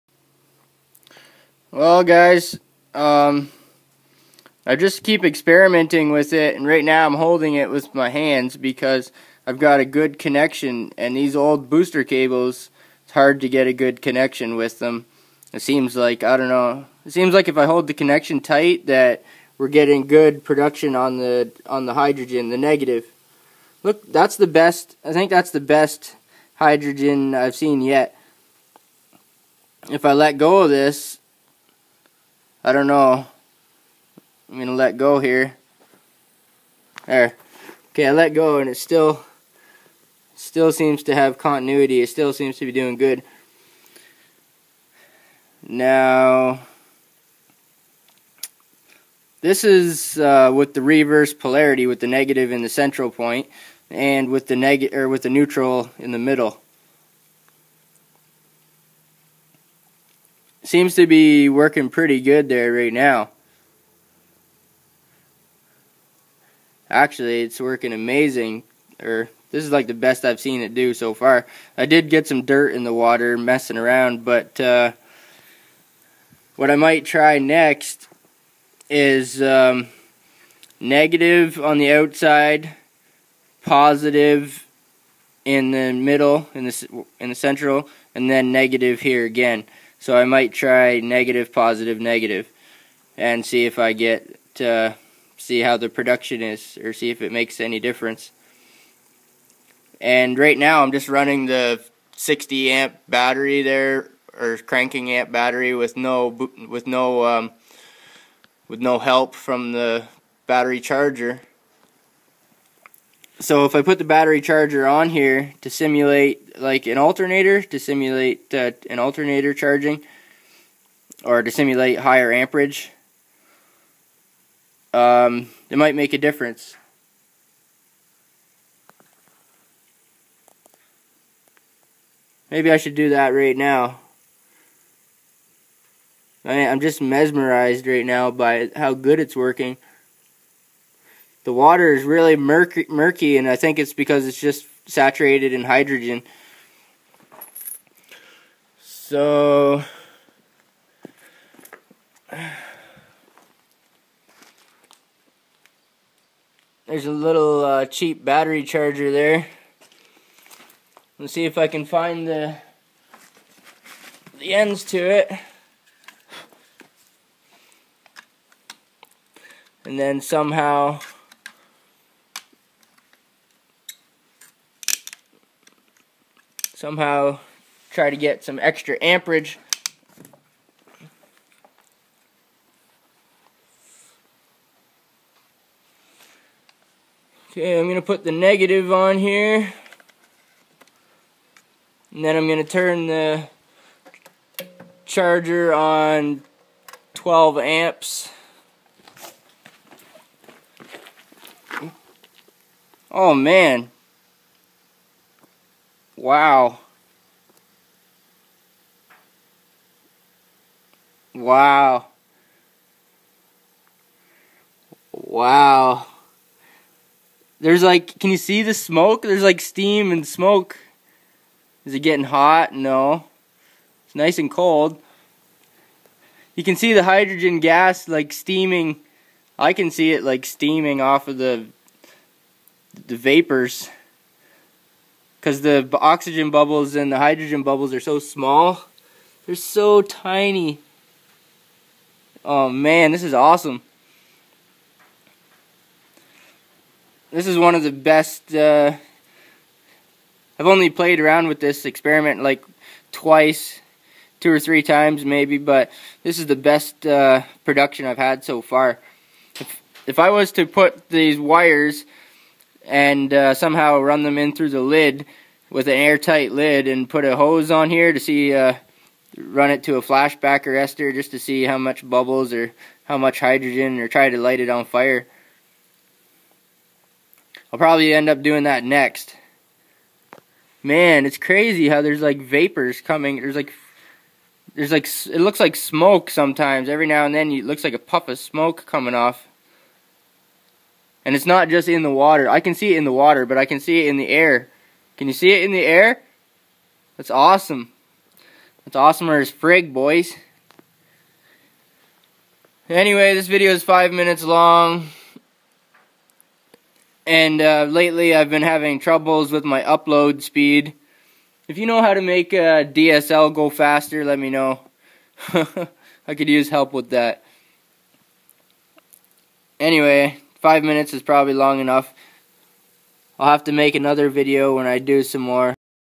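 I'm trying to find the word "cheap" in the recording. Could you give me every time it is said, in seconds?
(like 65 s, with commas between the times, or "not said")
157 s.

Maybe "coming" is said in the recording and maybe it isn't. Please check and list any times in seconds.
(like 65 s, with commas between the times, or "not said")
282 s, 288 s.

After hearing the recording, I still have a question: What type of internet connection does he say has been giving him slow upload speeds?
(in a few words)
DSL.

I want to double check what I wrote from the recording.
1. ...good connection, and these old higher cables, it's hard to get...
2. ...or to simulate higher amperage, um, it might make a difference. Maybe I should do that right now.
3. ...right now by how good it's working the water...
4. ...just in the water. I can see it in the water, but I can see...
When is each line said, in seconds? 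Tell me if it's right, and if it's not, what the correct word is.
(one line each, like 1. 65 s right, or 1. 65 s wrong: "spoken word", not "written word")
1. 9 s wrong: "booster", not "higher"
2. 121 s right
3. 137 s right
4. 291 s right.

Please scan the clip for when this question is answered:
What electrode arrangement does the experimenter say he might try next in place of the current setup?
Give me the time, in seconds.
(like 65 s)
90 s.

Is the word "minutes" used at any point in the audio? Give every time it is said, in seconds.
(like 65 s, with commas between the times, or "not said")
304 s, 320 s.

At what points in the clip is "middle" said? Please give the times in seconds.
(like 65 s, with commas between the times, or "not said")
56 s, 85 s.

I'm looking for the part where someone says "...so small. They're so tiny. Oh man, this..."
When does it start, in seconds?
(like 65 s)
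237 s.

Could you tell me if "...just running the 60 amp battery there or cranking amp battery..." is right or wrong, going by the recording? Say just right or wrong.
right.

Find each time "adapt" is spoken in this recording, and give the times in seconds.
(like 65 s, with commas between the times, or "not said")
not said.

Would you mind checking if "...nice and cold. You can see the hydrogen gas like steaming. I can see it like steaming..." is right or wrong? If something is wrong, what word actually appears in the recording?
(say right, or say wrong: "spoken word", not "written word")
right.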